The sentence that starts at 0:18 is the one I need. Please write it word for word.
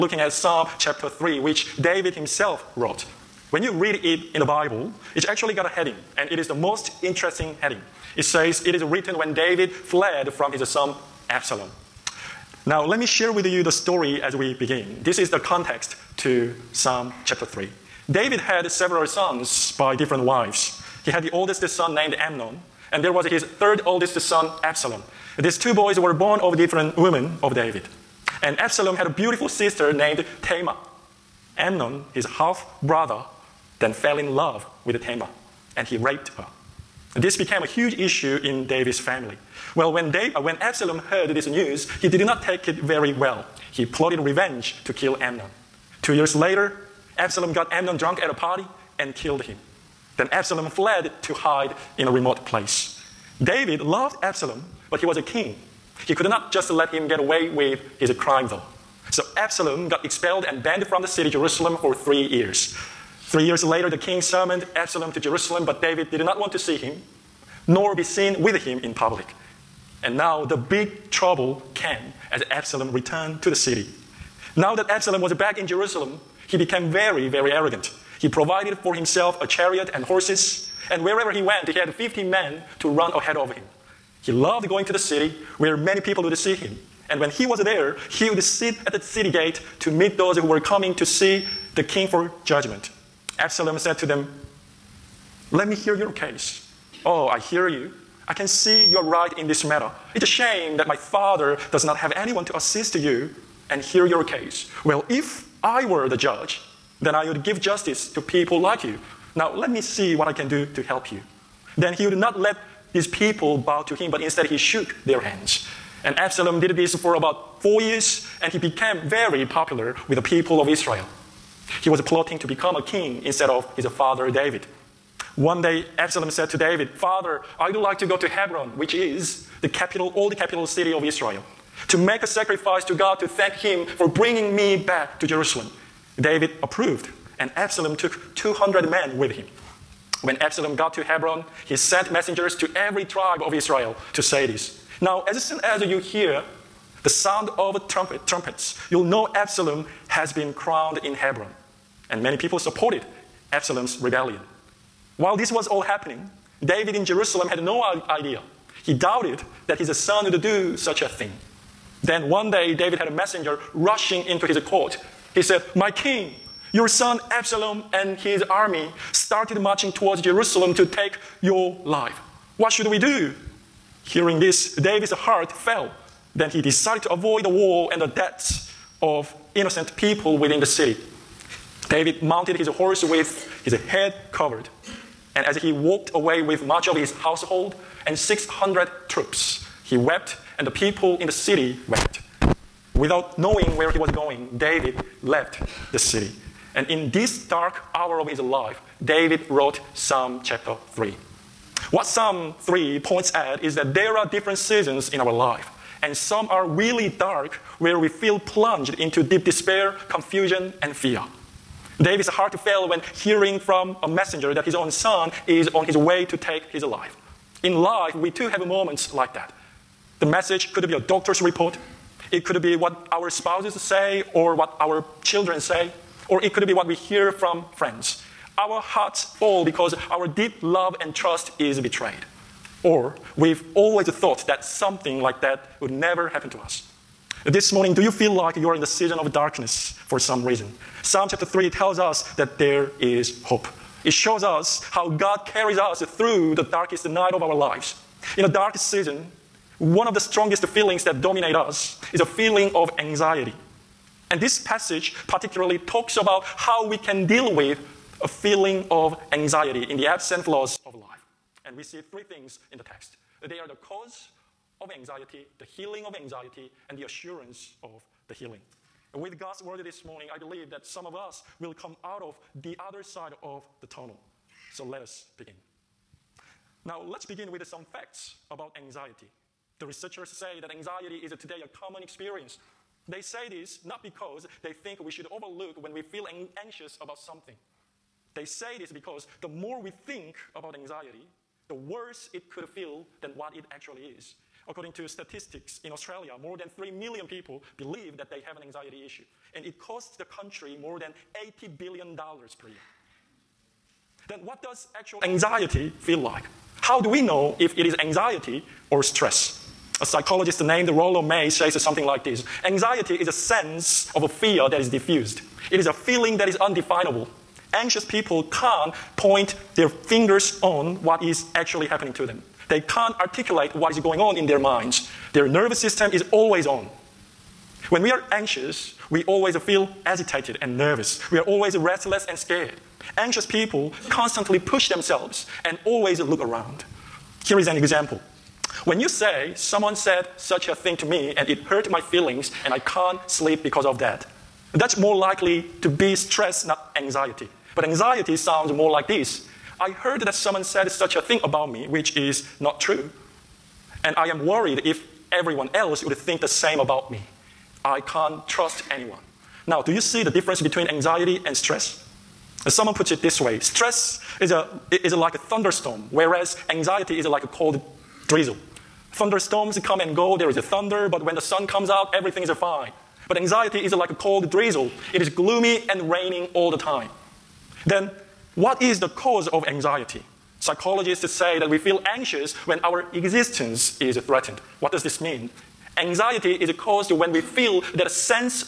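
David had several sons by different wives.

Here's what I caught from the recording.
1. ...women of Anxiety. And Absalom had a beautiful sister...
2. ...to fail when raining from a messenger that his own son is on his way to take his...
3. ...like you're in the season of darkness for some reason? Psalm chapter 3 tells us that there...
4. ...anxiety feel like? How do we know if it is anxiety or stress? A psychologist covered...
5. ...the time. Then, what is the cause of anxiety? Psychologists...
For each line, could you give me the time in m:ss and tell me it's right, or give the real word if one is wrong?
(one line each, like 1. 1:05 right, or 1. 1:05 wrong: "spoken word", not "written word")
1. 0:26 wrong: "David", not "Anxiety"
2. 3:32 wrong: "hearing", not "raining"
3. 3:58 right
4. 5:05 wrong: "named", not "covered"
5. 6:16 right.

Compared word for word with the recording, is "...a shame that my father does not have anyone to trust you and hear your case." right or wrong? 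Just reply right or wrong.
wrong.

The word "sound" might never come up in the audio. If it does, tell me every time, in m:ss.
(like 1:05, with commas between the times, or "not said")
2:27, 5:48.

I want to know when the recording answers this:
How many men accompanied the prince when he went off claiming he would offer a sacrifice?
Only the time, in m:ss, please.
2:18.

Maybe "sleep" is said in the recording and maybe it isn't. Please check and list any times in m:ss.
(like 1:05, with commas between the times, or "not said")
5:43.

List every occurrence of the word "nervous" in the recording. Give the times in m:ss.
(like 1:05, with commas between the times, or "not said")
5:25, 5:30.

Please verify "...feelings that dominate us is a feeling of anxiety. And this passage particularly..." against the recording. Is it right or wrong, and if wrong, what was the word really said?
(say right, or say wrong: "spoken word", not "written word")
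right.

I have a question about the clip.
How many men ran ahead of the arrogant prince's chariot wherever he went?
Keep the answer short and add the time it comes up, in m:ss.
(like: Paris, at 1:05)
50, at 1:21.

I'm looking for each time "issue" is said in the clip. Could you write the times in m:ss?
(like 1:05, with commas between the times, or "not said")
0:37, 4:59.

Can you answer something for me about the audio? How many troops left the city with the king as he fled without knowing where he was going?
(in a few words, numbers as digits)
600.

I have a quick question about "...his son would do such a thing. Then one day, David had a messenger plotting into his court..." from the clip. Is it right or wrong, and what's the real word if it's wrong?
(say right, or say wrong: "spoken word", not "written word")
wrong: "rushing", not "plotting".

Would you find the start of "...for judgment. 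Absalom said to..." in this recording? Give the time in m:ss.
1:32.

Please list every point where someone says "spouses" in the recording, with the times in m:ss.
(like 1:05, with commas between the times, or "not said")
3:43.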